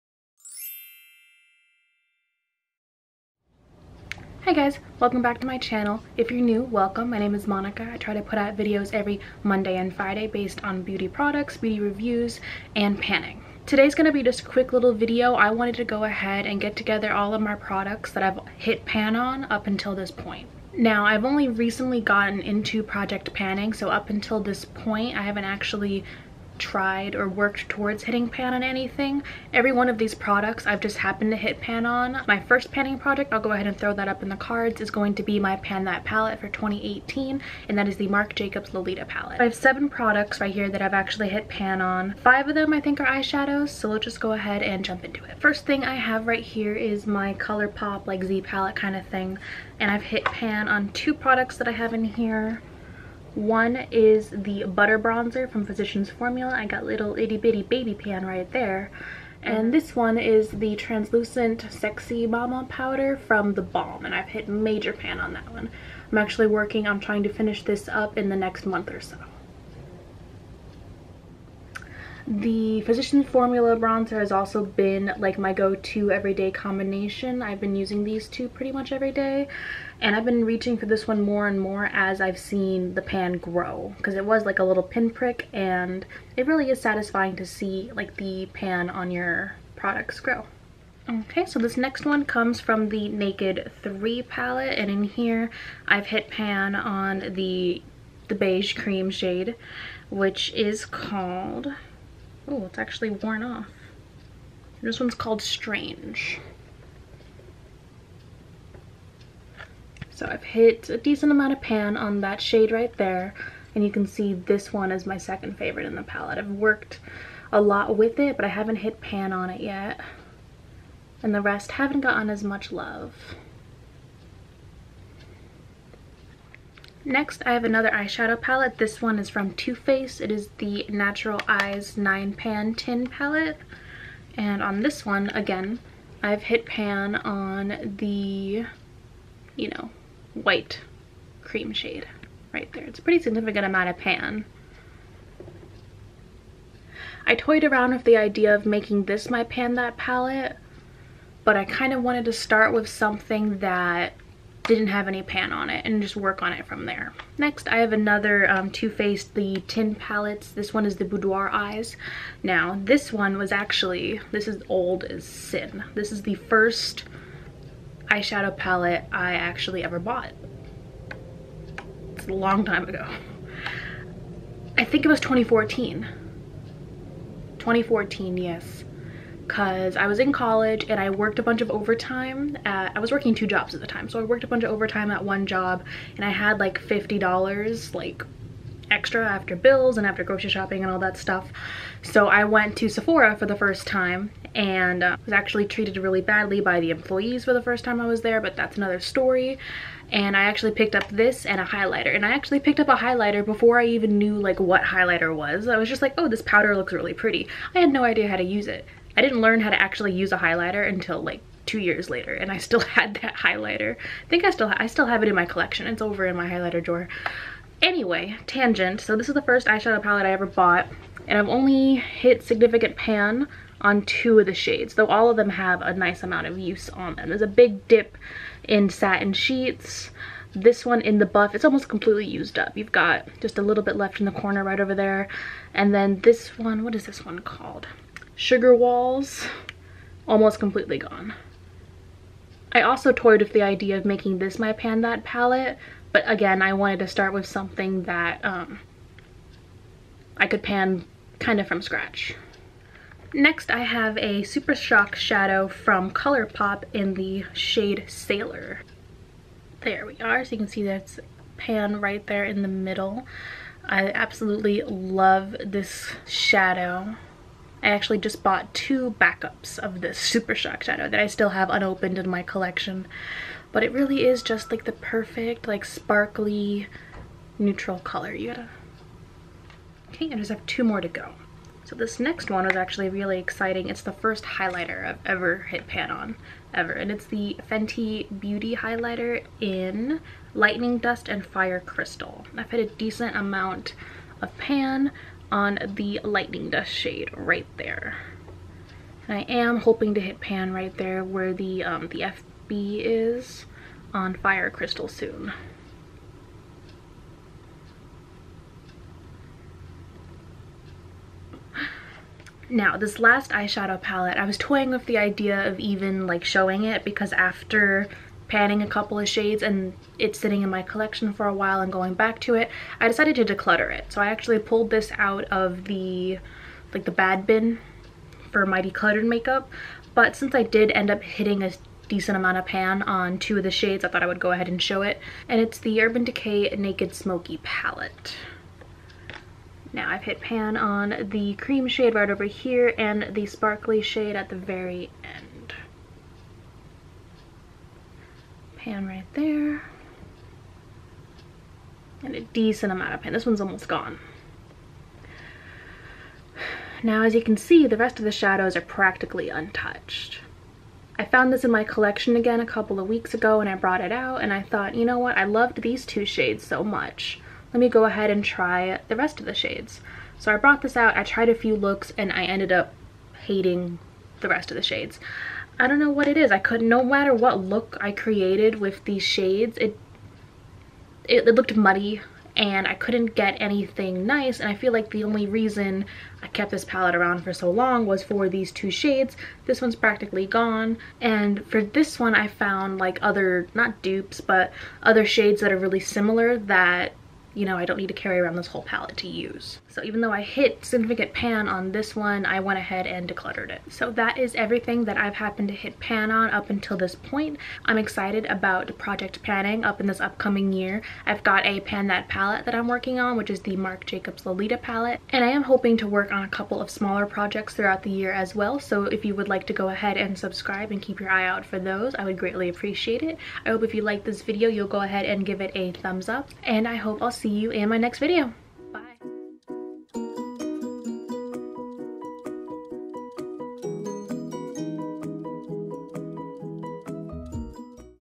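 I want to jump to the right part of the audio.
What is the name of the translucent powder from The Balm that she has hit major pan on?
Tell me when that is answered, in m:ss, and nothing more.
1:01.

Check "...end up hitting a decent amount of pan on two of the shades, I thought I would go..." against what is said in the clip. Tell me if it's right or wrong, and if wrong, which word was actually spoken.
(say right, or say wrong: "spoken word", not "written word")
right.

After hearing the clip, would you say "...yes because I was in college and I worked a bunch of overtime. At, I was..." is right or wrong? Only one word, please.
right.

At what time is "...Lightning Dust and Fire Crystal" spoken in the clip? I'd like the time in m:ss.
4:50.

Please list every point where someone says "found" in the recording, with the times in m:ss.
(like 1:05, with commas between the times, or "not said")
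6:01, 6:32.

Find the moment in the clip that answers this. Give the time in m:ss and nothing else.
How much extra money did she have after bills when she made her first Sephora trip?
3:06.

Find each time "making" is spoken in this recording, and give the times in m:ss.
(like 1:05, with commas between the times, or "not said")
2:28, 4:04.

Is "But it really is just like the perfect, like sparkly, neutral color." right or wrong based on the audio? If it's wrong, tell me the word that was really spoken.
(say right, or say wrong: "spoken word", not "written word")
right.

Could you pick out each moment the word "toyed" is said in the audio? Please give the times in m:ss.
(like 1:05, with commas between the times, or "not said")
2:27, 4:03.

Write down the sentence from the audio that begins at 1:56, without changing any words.
I've worked a lot with it, but I haven't hit pan on it yet.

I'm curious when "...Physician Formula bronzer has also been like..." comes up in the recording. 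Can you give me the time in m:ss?
1:12.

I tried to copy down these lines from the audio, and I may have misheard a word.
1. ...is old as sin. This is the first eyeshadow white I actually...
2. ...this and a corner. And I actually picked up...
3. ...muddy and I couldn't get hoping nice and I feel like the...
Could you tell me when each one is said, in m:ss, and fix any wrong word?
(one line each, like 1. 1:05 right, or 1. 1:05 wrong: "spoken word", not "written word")
1. 2:44 wrong: "palette", not "white"
2. 3:21 wrong: "highlighter", not "corner"
3. 6:21 wrong: "anything", not "hoping".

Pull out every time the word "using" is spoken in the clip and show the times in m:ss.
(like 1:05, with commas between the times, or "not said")
1:17.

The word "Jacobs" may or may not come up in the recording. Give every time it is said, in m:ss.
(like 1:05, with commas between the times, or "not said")
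0:38, 6:54.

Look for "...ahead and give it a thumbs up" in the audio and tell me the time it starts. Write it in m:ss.
7:05.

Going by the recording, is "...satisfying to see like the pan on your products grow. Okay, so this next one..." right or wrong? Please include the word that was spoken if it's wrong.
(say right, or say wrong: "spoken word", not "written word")
right.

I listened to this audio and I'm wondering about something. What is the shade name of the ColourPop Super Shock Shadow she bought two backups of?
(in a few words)
Sailor.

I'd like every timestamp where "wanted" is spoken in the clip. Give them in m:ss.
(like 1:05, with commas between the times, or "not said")
0:15, 2:32, 4:06.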